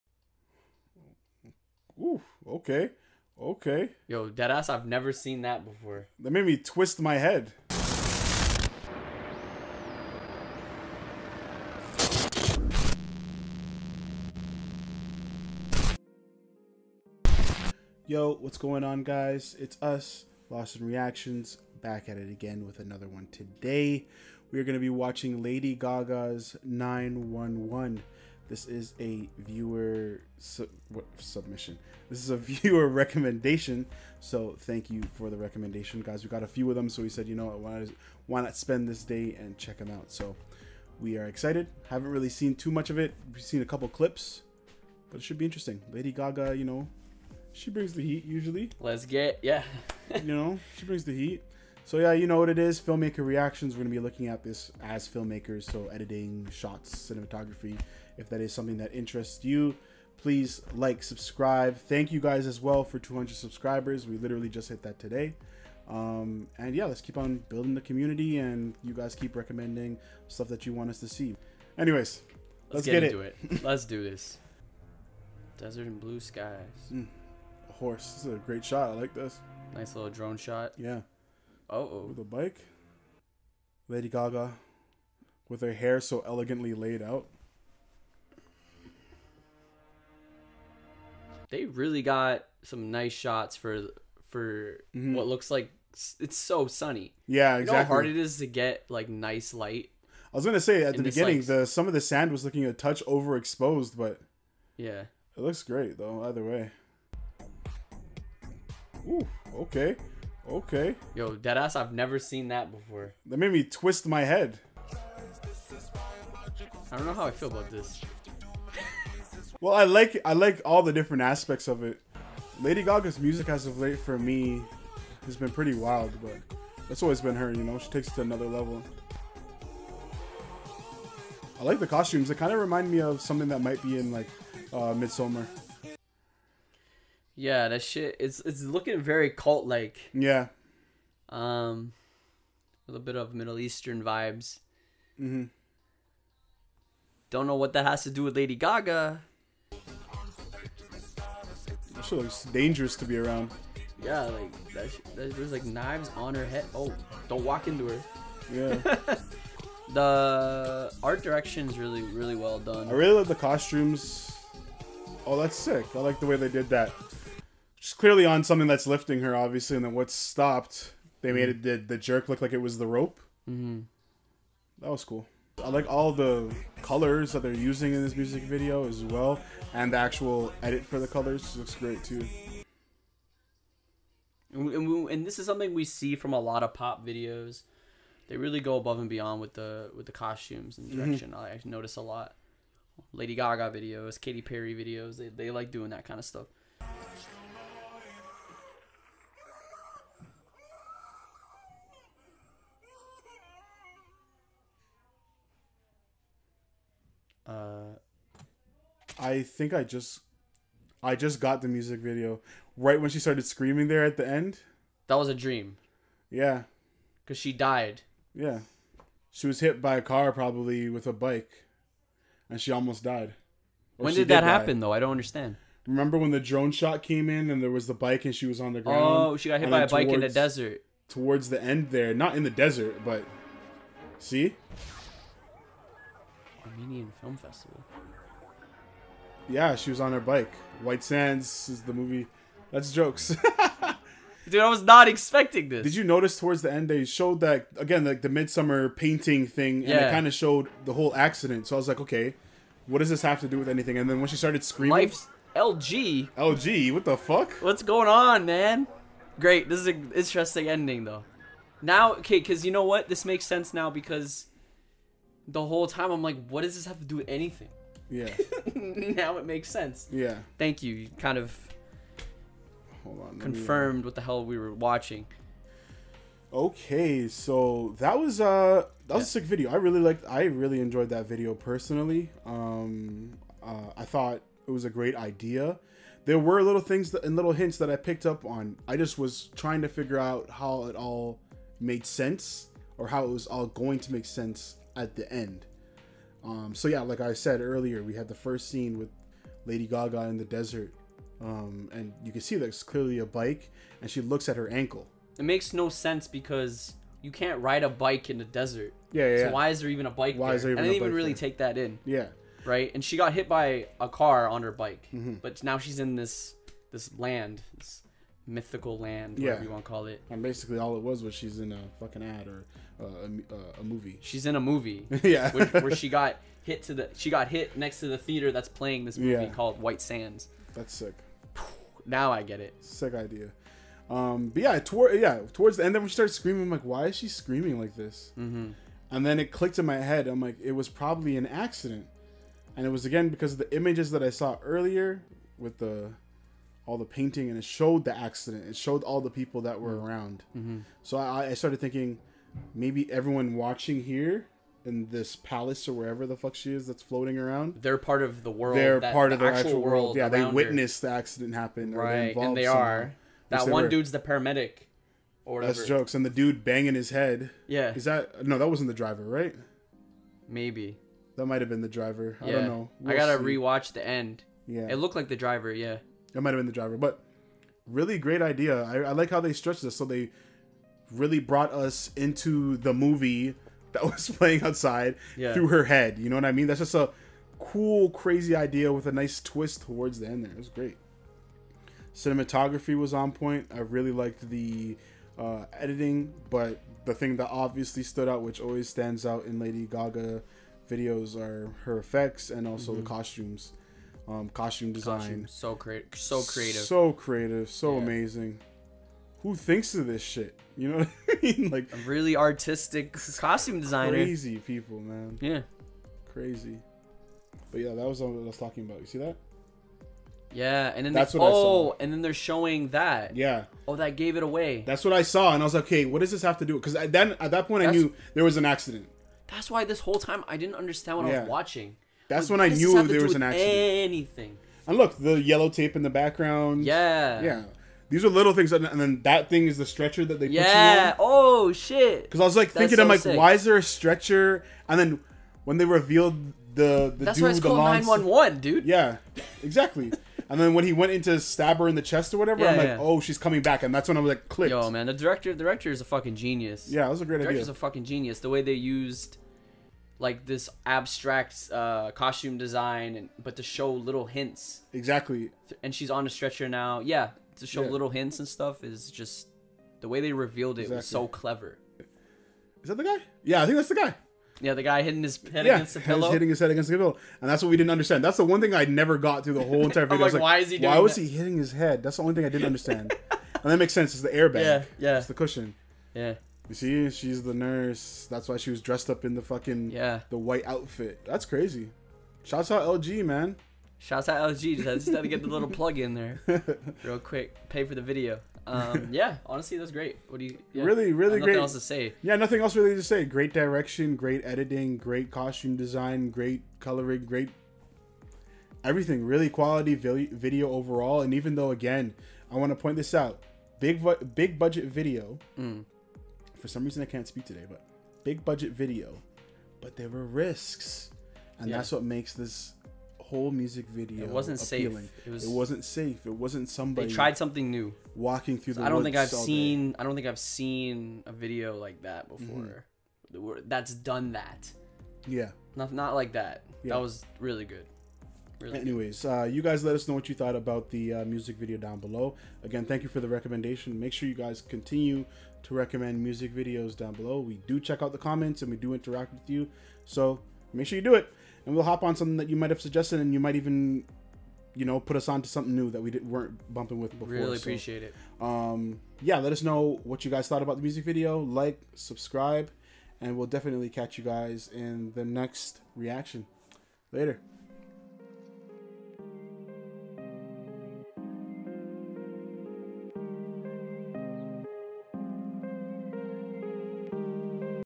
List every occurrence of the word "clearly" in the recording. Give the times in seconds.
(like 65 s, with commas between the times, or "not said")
167 s, 302 s.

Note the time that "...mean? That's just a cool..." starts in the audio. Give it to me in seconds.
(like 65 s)
386 s.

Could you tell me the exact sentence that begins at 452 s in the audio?
oh, she's coming back, and that's when I was like, clicked.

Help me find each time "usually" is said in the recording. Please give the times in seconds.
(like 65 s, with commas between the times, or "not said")
48 s.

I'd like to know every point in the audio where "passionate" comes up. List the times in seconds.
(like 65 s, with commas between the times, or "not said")
not said.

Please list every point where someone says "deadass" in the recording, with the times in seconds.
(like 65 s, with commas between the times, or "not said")
4 s, 111 s.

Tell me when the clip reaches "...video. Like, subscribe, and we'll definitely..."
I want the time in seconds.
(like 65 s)
561 s.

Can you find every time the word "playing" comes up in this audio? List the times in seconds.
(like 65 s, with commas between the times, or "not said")
328 s, 384 s.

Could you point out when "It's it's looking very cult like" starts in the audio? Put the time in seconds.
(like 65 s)
138 s.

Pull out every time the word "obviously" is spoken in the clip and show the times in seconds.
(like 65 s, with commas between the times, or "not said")
169 s, 397 s.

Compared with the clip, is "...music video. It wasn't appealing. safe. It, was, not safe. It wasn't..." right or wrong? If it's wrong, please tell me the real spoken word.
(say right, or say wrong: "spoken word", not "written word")
right.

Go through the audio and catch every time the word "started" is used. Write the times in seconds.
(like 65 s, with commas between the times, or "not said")
213 s, 254 s, 336 s, 351 s.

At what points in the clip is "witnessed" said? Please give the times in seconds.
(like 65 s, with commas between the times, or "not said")
360 s.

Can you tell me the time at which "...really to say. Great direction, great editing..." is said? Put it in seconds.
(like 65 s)
502 s.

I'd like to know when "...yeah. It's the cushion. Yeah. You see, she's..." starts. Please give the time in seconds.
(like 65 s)
484 s.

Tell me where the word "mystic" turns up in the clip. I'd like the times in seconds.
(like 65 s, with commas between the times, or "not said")
not said.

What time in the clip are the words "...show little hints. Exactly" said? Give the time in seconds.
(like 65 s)
463 s.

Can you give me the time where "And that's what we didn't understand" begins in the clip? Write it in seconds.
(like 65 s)
477 s.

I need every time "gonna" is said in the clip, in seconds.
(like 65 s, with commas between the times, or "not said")
53 s, 100 s.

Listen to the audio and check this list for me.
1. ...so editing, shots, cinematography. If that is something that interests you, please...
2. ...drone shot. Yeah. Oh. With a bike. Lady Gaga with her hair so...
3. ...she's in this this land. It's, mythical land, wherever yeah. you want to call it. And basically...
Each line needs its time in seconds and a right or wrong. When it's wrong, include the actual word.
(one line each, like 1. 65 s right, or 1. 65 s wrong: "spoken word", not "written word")
1. 55 s right
2. 80 s right
3. 315 s wrong: "whatever", not "wherever".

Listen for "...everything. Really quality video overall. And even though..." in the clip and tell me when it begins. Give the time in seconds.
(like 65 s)
508 s.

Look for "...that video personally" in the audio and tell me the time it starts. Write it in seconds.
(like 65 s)
281 s.